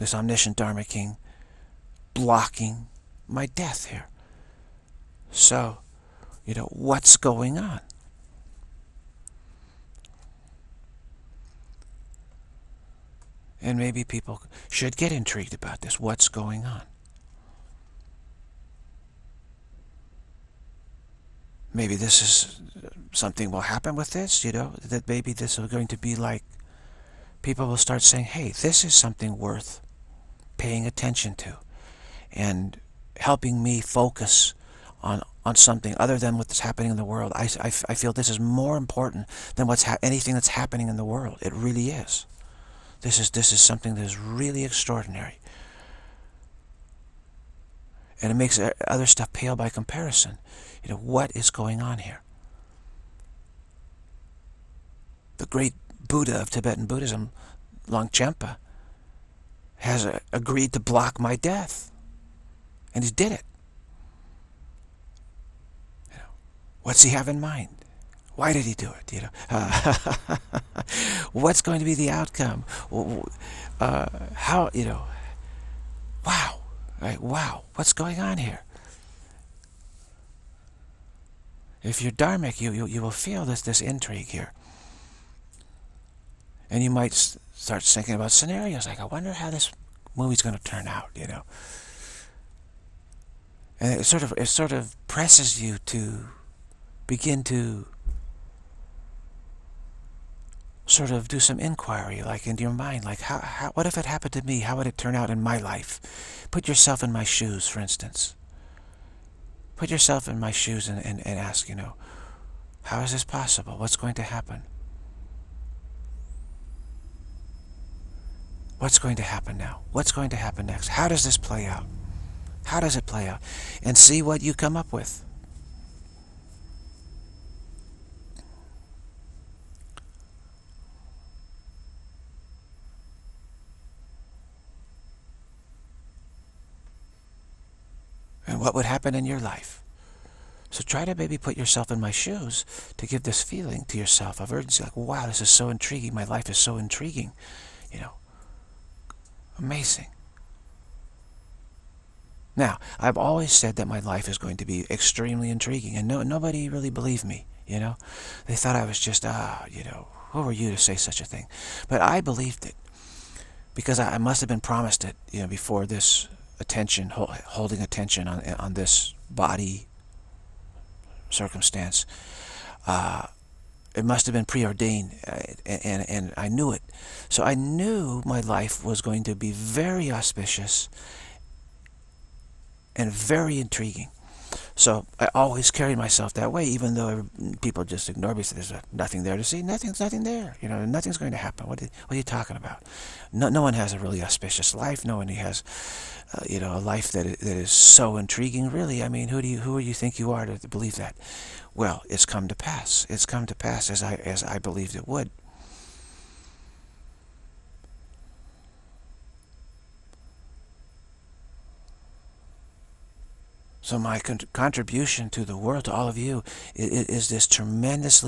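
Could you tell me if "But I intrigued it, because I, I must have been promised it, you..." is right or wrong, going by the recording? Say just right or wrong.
wrong.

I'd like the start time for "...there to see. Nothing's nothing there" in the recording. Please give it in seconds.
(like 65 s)
189 s.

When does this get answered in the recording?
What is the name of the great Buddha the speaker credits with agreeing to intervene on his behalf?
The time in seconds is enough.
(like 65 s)
57 s.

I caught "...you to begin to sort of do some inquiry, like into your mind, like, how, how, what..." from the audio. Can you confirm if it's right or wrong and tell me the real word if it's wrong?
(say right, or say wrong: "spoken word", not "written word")
right.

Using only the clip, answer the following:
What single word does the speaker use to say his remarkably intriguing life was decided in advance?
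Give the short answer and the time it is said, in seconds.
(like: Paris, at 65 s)
Preordained, at 174 s.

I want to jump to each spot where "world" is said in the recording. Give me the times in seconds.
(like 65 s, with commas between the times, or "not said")
37 s, 41 s, 215 s.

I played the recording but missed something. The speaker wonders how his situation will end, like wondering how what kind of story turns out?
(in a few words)
Movie.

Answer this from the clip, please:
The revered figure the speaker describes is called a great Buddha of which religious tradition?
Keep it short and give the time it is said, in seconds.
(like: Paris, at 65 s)
Tibetan Buddhism, at 56 s.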